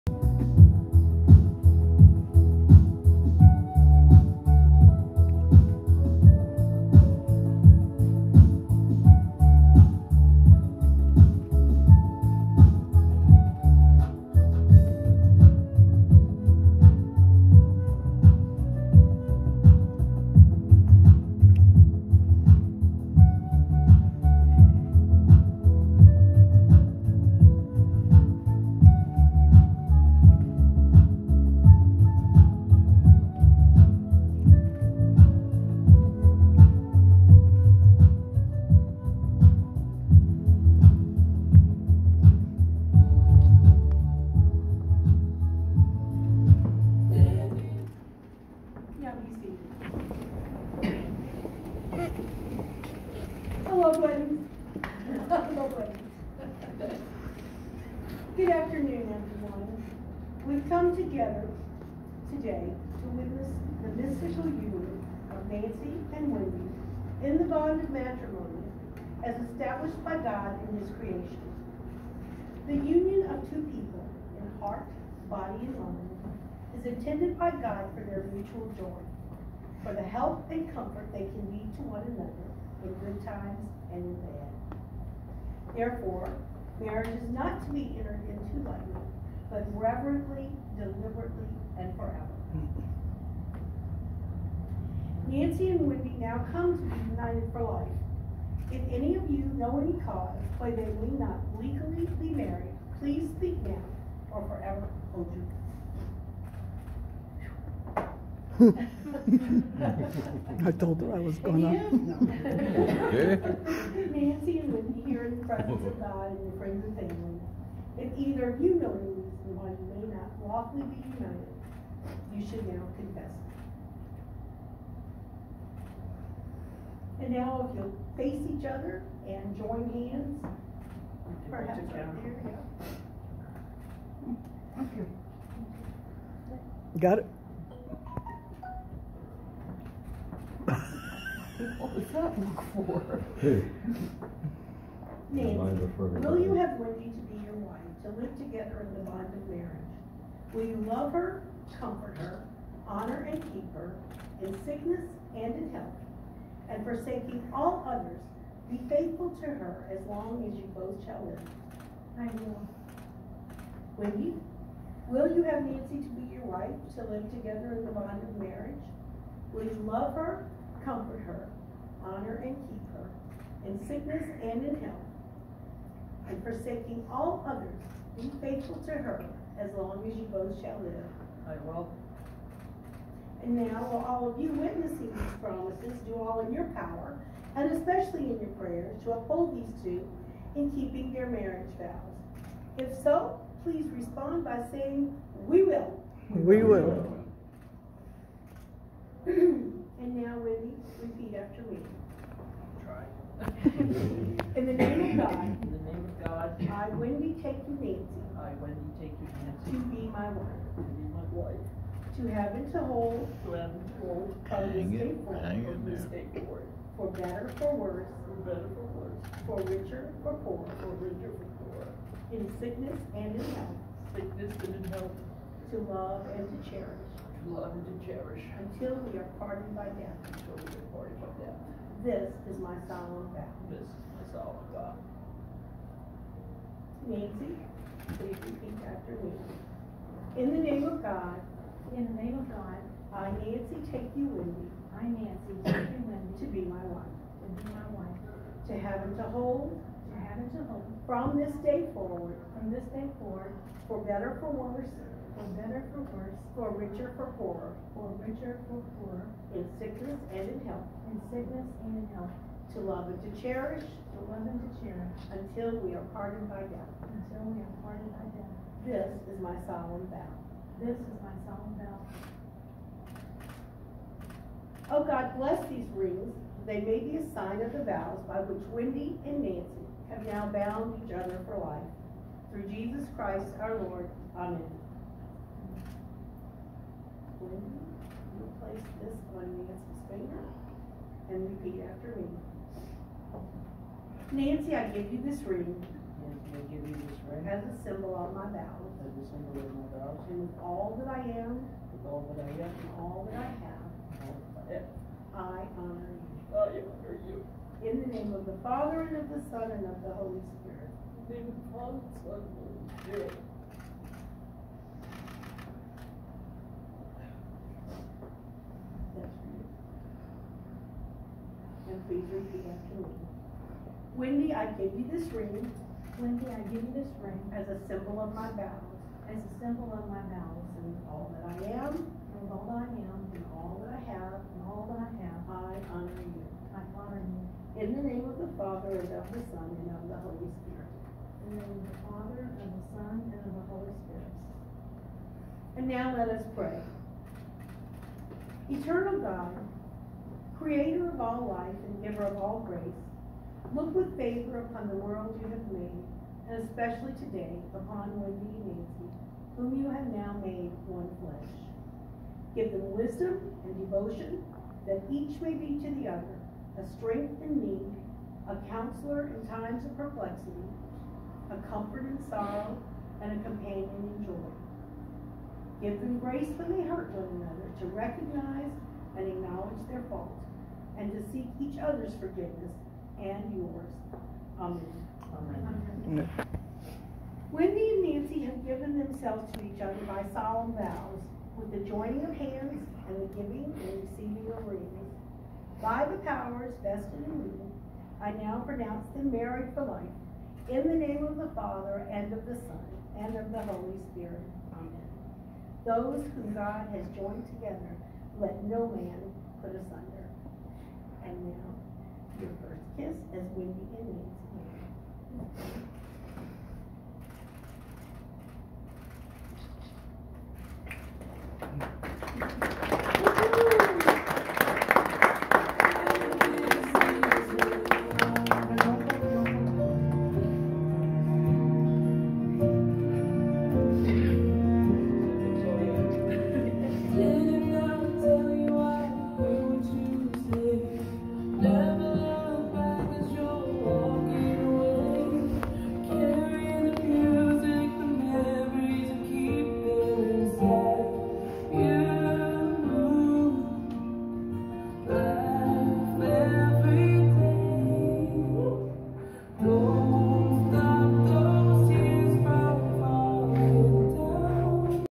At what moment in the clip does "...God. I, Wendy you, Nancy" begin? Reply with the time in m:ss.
3:26.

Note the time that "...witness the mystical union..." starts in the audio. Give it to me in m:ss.
1:03.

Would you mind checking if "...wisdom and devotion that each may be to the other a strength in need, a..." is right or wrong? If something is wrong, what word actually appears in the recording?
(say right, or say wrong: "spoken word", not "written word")
right.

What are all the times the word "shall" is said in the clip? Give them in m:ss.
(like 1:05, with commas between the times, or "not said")
2:41, 3:00.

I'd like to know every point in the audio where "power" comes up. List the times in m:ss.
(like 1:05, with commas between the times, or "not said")
3:06, 6:36.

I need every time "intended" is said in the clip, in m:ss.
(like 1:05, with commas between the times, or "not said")
1:16.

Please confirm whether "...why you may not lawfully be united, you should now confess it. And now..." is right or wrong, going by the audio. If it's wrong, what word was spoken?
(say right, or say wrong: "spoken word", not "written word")
right.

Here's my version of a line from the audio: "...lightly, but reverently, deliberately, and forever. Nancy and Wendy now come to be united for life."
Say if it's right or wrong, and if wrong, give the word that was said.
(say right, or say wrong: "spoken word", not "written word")
right.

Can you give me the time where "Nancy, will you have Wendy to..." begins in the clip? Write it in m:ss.
2:25.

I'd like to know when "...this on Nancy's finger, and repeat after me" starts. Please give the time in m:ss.
4:49.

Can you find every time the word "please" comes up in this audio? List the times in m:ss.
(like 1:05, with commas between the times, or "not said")
1:42, 3:13, 3:58, 5:22.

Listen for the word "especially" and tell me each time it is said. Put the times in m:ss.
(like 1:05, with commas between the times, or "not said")
3:07, 5:56.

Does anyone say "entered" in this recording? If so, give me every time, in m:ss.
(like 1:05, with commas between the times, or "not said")
1:27.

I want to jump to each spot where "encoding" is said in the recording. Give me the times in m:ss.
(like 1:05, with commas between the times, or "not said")
not said.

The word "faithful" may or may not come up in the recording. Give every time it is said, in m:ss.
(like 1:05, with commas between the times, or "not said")
2:38, 2:58.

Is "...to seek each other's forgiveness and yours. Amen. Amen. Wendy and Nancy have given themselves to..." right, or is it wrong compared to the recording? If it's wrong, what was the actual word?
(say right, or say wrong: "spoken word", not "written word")
right.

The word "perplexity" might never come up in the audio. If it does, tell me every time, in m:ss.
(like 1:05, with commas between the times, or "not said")
6:09.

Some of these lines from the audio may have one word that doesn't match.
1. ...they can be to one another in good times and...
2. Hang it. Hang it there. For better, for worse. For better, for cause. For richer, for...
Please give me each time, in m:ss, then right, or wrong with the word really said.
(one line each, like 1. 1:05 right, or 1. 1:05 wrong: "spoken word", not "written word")
1. 1:21 right
2. 3:34 wrong: "worse", not "cause".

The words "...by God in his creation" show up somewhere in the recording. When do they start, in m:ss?
1:10.